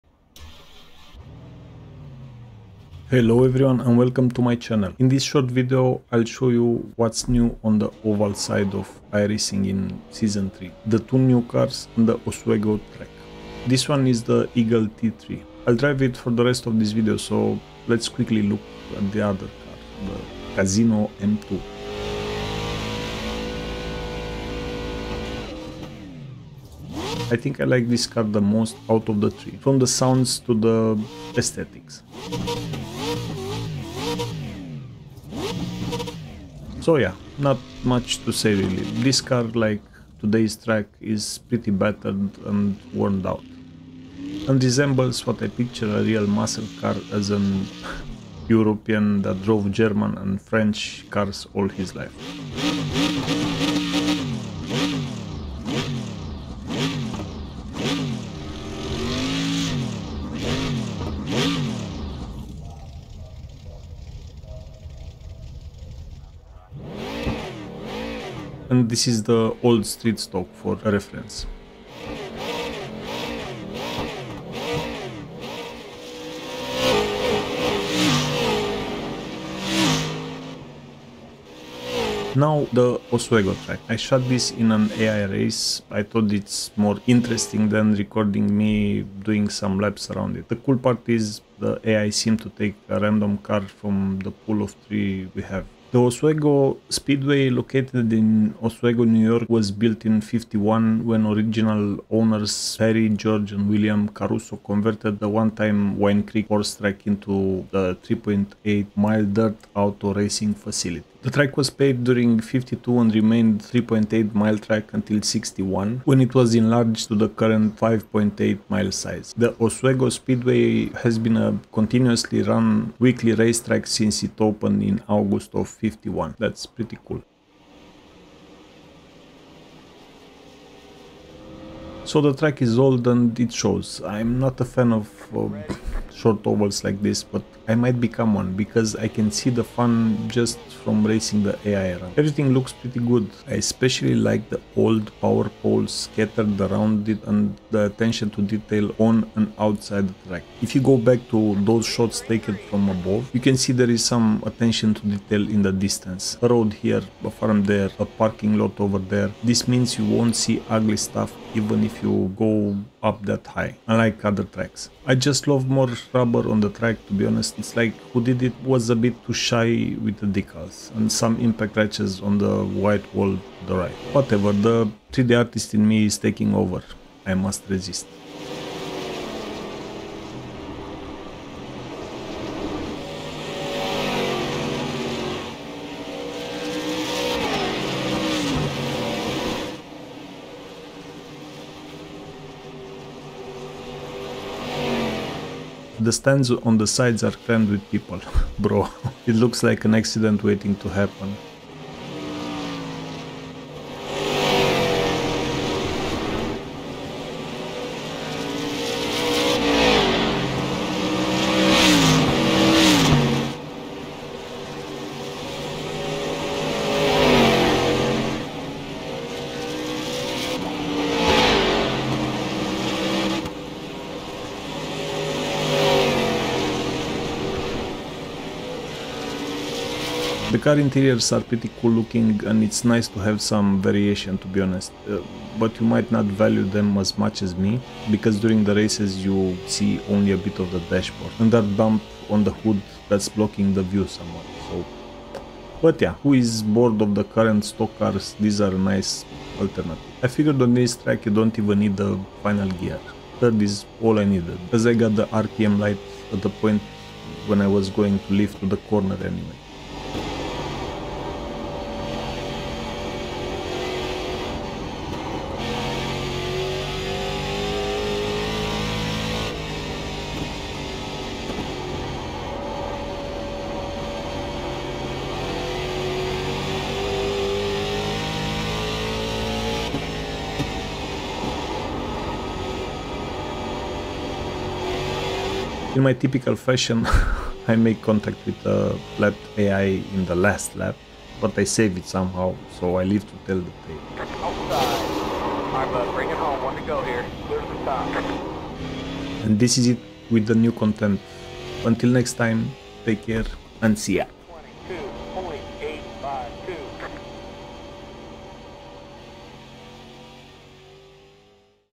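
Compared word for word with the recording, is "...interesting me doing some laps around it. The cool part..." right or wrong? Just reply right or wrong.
wrong.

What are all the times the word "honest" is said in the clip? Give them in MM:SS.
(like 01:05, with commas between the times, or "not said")
02:47, 03:54.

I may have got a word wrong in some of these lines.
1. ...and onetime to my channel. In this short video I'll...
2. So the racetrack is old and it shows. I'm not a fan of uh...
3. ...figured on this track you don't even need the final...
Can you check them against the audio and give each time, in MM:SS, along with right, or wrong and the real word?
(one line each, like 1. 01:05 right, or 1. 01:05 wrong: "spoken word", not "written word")
1. 00:03 wrong: "welcome", not "onetime"
2. 02:12 wrong: "track", not "racetrack"
3. 04:10 right.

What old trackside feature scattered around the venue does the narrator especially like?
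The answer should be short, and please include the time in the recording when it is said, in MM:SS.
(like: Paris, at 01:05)
power poles, at 02:25.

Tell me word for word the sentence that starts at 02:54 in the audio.
Whatever, the 3D artist in me is taking over.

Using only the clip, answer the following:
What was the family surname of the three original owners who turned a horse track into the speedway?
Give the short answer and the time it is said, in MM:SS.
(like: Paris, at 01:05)
Caruso, at 01:44.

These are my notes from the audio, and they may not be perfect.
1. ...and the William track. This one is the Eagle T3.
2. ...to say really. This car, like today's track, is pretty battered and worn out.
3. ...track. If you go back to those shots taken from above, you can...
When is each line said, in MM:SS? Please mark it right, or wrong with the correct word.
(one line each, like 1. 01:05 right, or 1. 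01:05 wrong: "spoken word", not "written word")
1. 00:11 wrong: "Oswego", not "William"
2. 00:38 right
3. 02:30 right.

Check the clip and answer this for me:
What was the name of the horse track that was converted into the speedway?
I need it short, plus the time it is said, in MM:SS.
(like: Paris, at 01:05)
Wine Creek, at 01:45.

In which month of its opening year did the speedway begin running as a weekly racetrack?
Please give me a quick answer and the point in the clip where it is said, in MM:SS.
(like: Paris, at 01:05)
August, at 02:05.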